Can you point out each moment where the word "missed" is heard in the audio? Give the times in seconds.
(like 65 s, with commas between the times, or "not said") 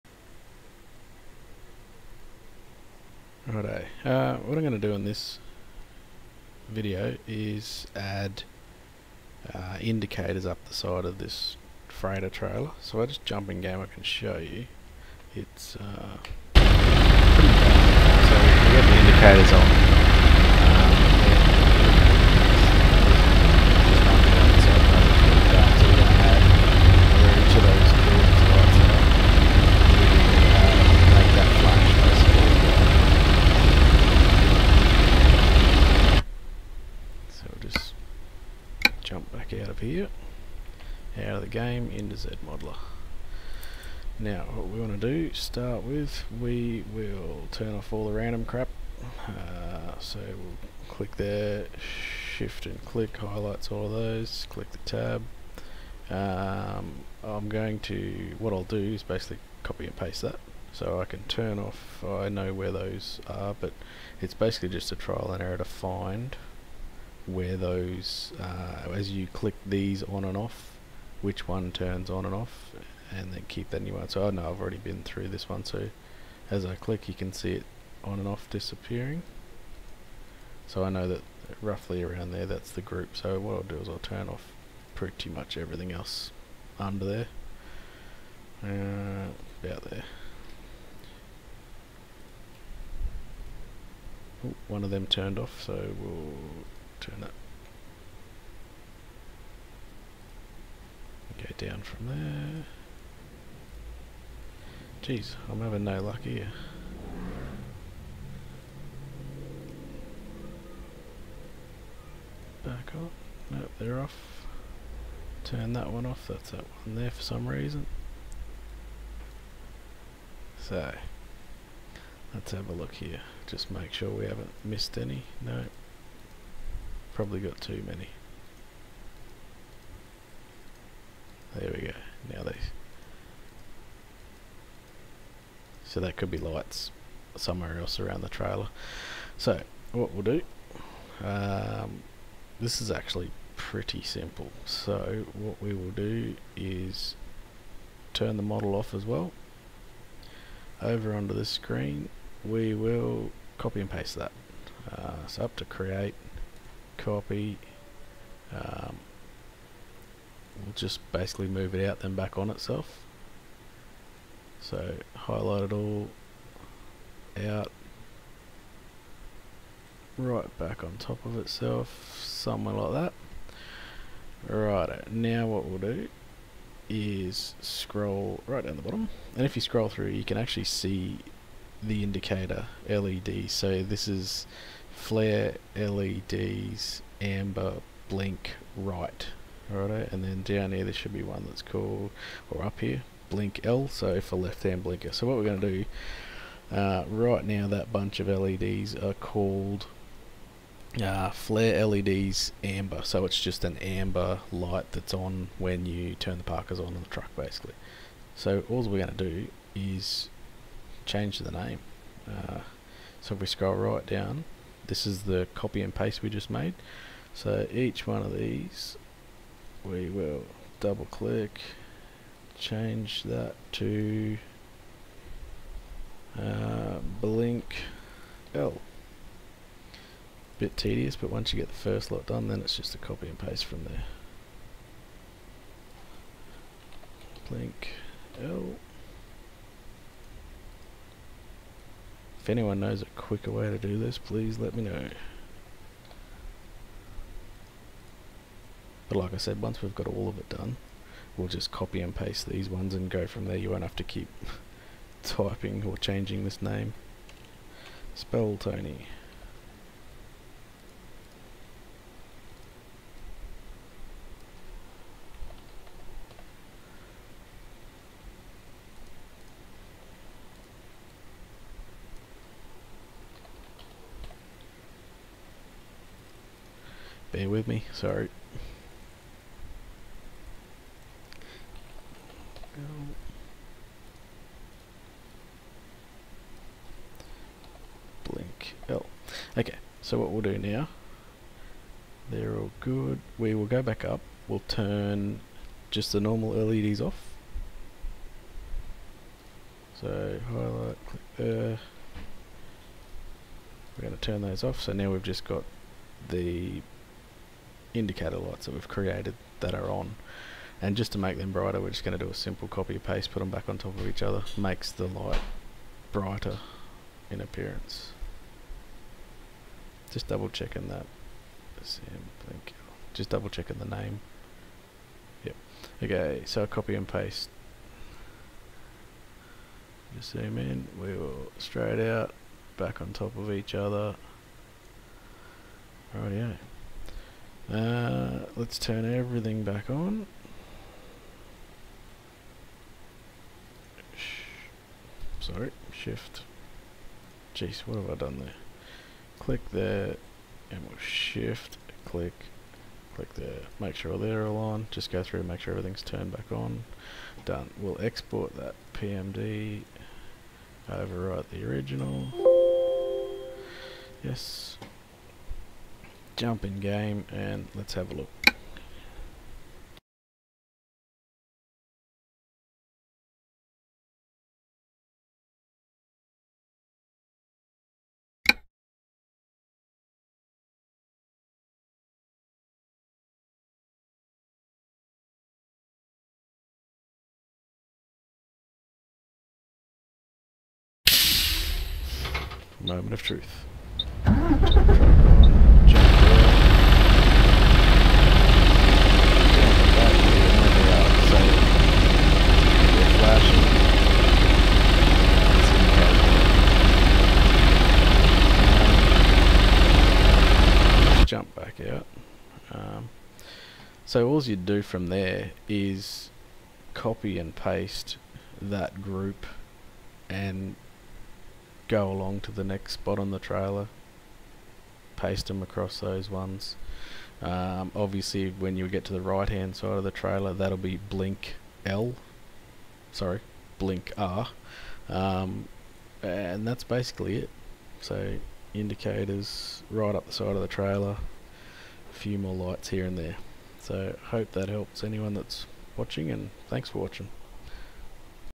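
124 s.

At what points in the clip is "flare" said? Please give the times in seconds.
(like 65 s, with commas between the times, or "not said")
184 s, 201 s.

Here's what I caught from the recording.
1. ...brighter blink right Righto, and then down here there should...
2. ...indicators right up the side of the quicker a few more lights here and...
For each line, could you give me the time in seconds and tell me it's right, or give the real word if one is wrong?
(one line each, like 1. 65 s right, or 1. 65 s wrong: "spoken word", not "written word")
1. 187 s wrong: "amber", not "brighter"
2. 438 s wrong: "trailer", not "quicker".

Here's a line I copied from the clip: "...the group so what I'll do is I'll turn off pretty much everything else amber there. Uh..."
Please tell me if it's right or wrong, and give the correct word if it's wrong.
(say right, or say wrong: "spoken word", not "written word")
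wrong: "under", not "amber".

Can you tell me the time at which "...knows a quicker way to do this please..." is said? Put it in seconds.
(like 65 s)
242 s.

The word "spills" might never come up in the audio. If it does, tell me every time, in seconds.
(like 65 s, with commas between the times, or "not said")
not said.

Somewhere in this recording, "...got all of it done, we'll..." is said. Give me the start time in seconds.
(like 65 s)
249 s.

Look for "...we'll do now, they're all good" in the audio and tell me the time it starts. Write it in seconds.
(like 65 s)
290 s.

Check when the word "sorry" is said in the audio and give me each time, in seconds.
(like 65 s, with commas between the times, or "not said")
277 s, 345 s, 433 s.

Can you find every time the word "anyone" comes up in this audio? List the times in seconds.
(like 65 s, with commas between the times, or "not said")
242 s, 445 s.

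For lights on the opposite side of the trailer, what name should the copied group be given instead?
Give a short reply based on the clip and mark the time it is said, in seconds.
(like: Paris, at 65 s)
blink R, at 433 s.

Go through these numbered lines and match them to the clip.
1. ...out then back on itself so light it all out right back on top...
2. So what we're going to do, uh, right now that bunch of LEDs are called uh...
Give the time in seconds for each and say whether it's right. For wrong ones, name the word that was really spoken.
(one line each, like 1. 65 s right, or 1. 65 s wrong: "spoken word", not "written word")
1. 161 s wrong: "highlight", not "light"
2. 195 s right.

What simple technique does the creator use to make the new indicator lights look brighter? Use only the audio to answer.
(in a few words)
copy paste.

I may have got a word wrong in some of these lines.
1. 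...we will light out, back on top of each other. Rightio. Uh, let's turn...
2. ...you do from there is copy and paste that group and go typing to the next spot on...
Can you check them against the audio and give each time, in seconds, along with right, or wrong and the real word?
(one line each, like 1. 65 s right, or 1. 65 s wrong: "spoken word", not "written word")
1. 331 s wrong: "straight", not "light"
2. 414 s wrong: "along", not "typing".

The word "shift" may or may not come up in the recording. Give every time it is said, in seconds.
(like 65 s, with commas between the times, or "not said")
52 s, 345 s, 350 s.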